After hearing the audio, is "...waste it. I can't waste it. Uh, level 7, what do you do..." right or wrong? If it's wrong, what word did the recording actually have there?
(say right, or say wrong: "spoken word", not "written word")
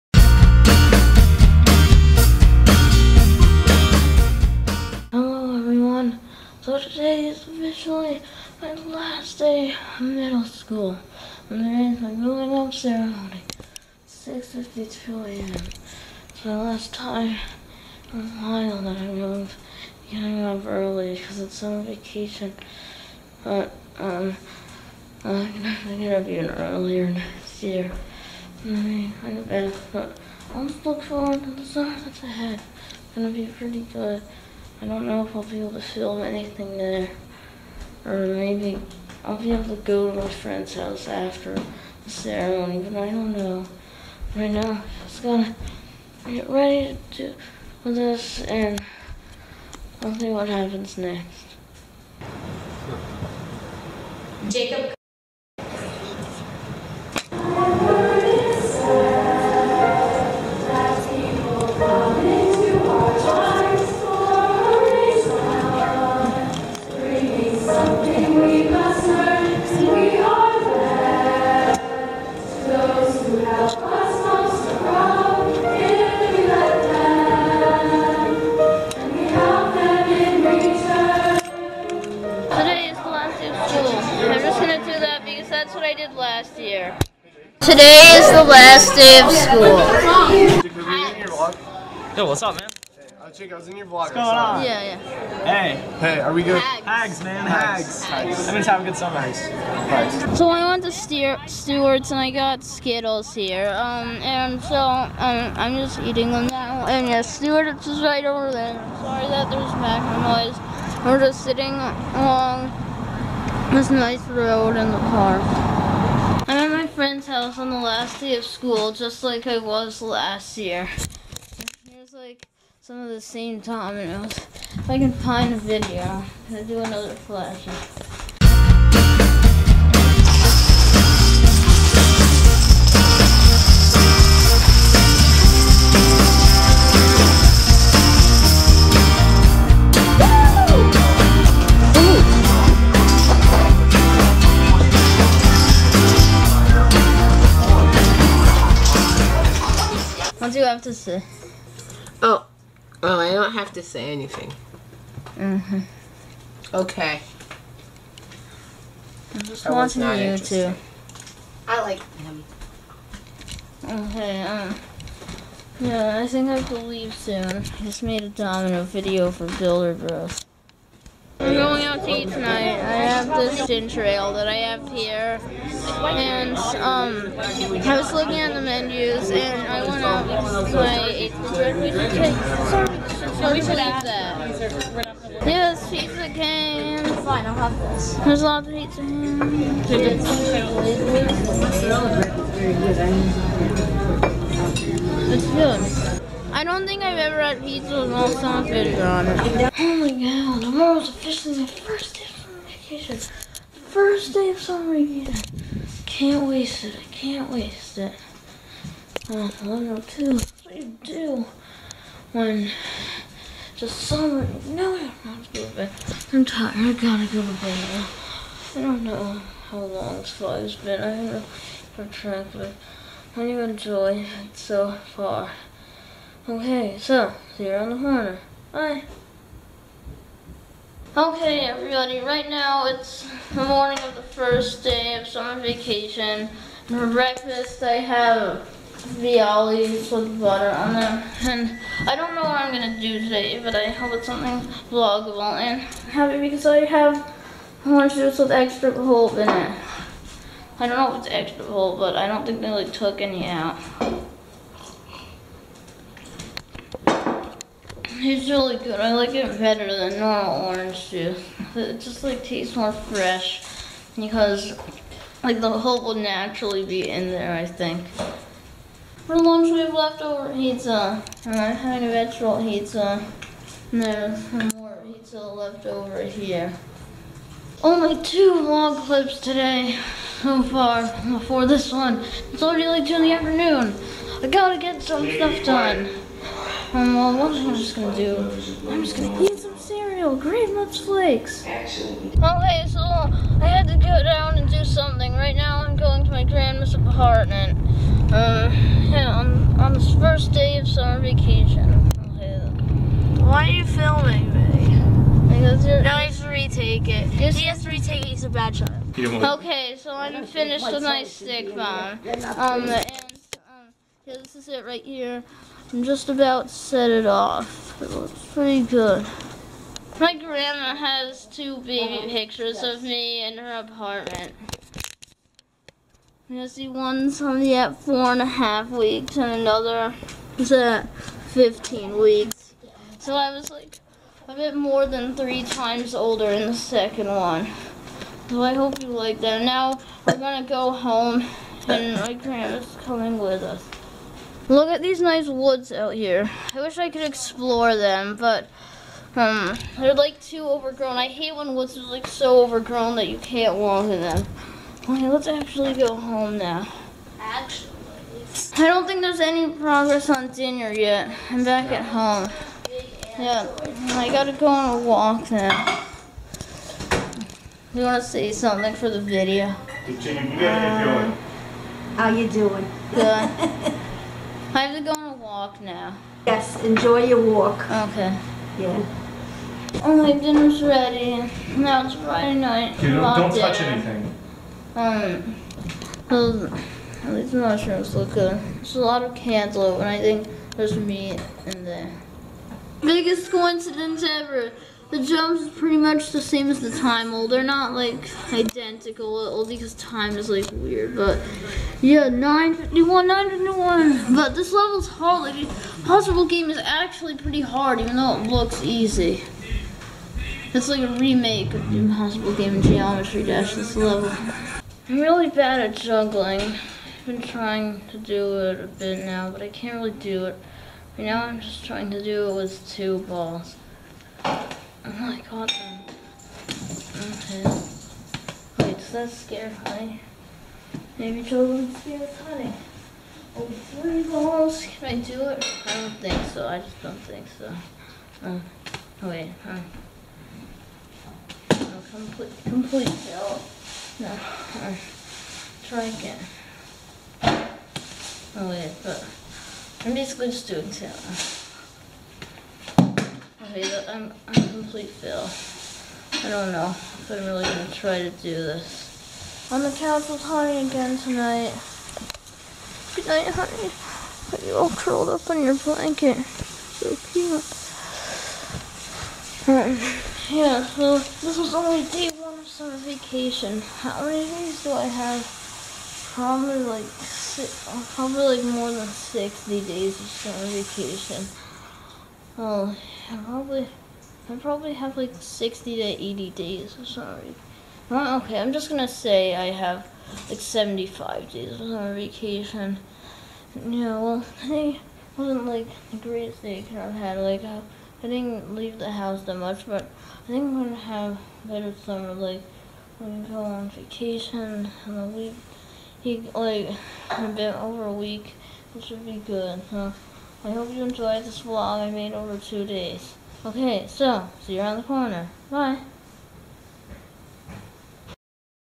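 wrong: "2", not "7".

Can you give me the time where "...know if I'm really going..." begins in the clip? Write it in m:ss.
7:36.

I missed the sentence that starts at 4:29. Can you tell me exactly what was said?
For lunch we have leftover pizza and I'm having a vegetable pizza.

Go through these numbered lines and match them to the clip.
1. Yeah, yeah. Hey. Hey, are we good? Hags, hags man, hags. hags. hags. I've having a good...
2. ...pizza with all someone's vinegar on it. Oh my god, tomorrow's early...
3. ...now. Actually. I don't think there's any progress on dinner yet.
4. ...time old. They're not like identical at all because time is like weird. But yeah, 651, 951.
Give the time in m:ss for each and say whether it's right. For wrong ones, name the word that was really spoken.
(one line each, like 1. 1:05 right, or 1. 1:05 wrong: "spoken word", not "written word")
1. 1:34 right
2. 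3:17 wrong: "officially", not "early"
3. 5:56 right
4. 6:36 wrong: "951", not "651".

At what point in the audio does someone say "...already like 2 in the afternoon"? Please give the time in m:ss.
4:42.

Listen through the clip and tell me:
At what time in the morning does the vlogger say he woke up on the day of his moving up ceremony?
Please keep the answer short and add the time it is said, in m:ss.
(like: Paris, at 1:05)
6:52 a.m., at 0:14.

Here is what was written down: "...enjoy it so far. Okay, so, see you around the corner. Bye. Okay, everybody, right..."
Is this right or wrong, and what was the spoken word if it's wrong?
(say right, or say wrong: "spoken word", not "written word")
right.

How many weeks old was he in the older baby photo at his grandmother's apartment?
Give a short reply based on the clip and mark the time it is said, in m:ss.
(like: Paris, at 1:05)
15 weeks, at 5:31.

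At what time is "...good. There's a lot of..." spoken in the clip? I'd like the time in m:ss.
6:28.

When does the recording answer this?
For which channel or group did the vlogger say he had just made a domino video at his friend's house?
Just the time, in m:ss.
2:49.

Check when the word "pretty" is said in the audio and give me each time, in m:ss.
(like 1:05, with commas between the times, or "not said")
0:33, 5:18, 6:35, 6:47.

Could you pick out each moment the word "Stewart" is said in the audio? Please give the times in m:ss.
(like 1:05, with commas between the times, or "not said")
1:41, 1:47.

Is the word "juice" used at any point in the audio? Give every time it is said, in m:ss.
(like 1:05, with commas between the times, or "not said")
4:08, 4:21.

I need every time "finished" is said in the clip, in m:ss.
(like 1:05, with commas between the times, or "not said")
5:10.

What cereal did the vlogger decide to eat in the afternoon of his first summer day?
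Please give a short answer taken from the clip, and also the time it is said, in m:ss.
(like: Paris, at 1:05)
Great Much Flakes, at 4:50.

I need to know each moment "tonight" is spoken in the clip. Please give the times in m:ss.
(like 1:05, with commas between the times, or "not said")
2:52, 7:41.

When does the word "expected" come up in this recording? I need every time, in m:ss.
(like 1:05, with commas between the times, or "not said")
not said.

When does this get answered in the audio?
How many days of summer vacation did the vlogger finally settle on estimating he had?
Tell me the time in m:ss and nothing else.
8:10.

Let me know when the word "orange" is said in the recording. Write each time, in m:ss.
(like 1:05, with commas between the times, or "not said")
4:07, 4:20.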